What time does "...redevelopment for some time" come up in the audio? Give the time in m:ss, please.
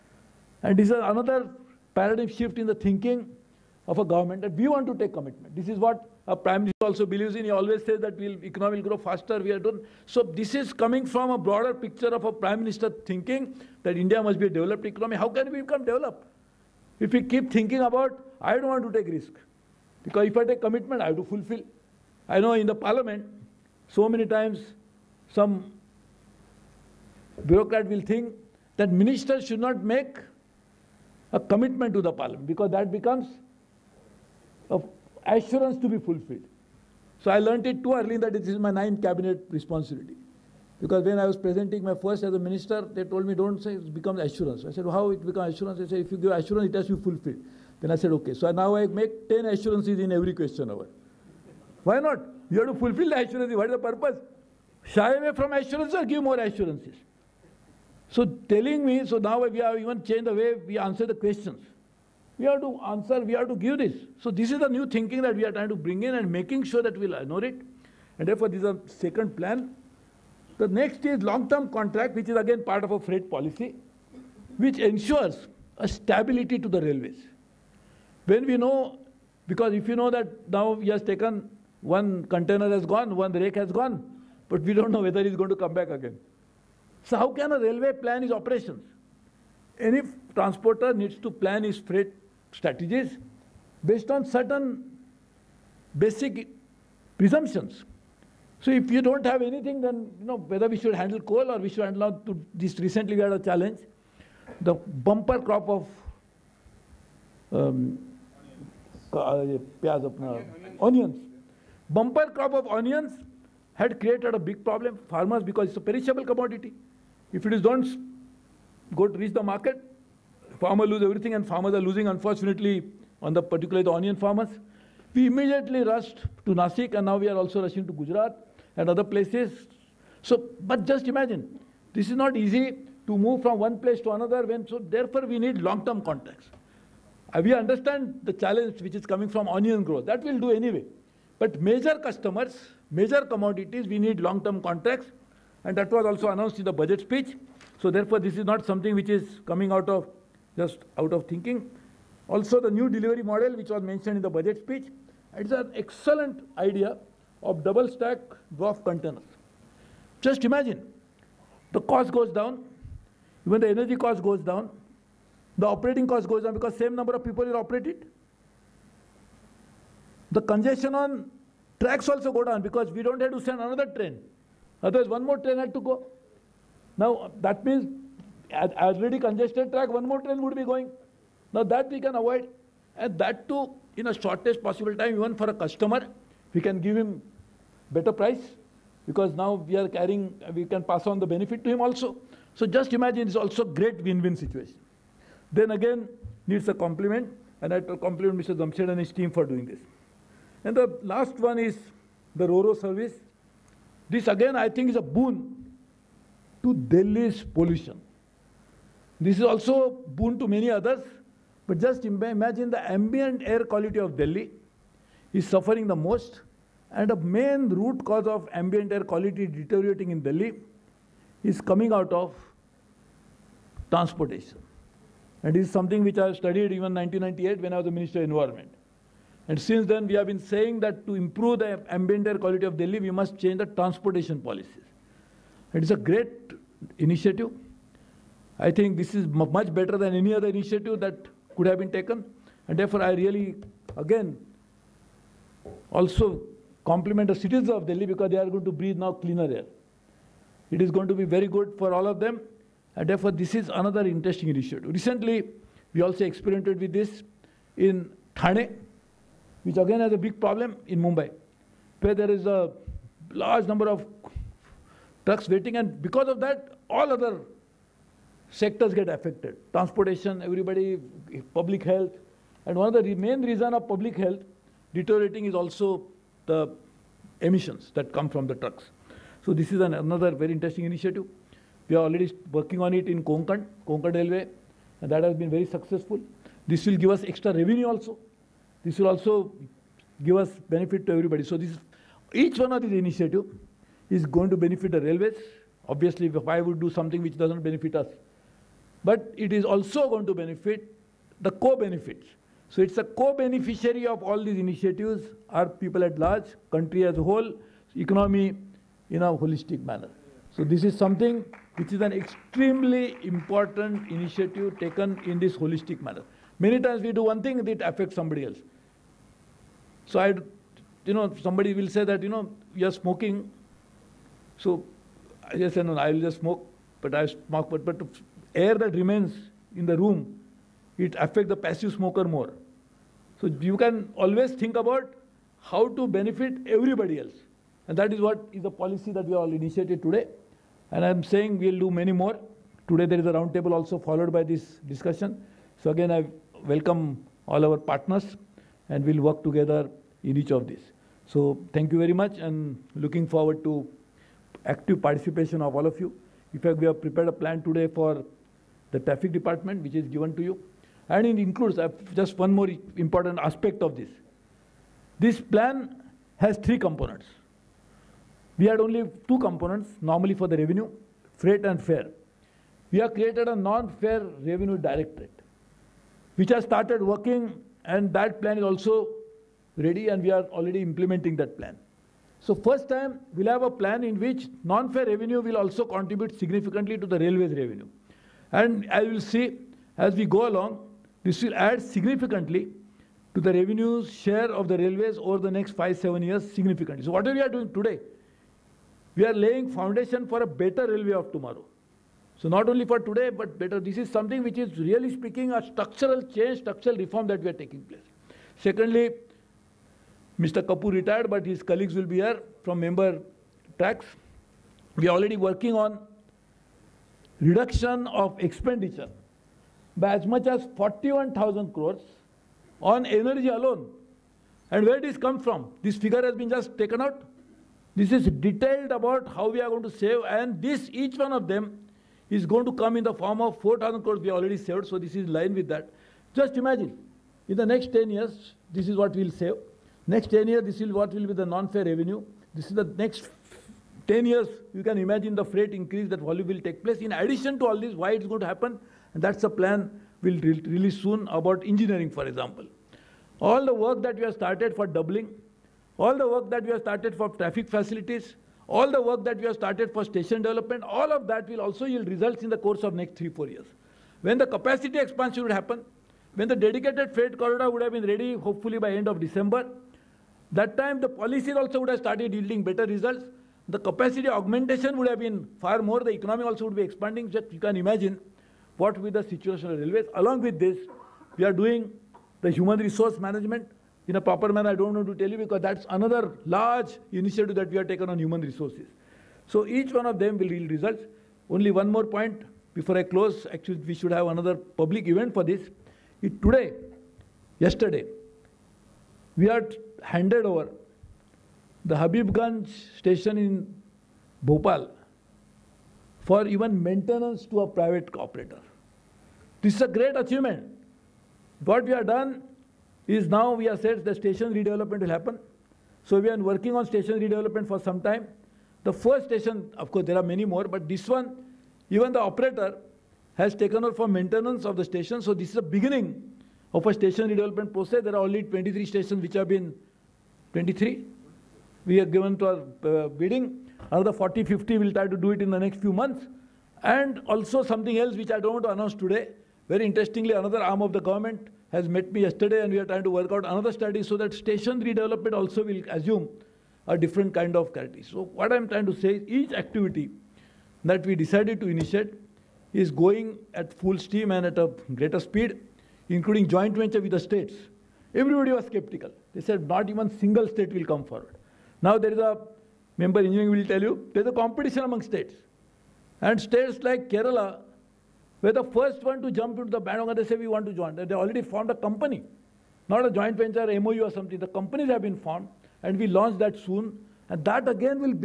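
8:37.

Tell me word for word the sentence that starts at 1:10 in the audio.
The next is long-term contract, which is again part of a freight policy, which ensures a stability to the railways.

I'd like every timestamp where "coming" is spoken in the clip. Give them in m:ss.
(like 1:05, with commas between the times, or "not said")
0:10, 2:19, 2:29, 3:41.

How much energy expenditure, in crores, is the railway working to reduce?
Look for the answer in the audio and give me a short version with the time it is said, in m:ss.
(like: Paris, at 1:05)
41,000 crores, at 7:00.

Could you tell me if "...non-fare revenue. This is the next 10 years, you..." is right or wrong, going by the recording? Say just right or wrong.
right.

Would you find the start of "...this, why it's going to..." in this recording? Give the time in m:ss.
7:27.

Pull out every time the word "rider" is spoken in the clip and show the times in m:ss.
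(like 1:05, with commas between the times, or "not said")
not said.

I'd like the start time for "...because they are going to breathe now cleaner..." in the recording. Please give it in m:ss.
4:08.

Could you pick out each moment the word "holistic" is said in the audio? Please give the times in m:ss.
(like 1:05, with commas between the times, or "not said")
5:09, 5:15.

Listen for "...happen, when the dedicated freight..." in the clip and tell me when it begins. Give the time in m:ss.
7:45.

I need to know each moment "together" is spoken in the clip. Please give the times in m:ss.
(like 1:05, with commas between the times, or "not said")
5:49.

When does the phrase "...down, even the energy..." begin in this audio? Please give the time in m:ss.
2:42.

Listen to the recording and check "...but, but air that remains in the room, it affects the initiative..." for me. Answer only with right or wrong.
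wrong.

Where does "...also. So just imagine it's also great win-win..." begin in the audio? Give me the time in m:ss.
3:11.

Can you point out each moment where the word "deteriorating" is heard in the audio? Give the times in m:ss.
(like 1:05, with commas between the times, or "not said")
3:39, 4:34.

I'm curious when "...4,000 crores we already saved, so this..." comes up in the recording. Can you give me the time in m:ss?
7:13.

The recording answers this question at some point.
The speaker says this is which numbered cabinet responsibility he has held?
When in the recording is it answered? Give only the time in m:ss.
0:38.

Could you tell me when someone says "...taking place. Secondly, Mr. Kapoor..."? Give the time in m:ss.
6:47.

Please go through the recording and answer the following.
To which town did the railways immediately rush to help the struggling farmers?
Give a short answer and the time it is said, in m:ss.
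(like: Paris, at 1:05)
Nasik, at 2:06.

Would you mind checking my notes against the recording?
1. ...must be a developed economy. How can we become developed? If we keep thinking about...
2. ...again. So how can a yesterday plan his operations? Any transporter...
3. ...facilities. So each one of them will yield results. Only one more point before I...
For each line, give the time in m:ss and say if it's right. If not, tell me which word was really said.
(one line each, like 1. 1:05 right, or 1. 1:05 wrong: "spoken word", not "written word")
1. 0:14 right
2. 1:25 wrong: "railway", not "yesterday"
3. 8:08 wrong: "resources", not "facilities".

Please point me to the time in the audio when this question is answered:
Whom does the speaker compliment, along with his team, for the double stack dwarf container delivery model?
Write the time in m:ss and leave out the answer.
3:18.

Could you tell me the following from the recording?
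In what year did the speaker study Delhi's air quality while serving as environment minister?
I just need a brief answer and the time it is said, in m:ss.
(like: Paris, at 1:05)
1998, at 3:47.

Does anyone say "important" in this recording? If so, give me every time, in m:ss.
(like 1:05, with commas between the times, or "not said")
5:13, 6:02.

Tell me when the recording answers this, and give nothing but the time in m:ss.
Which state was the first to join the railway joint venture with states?
9:27.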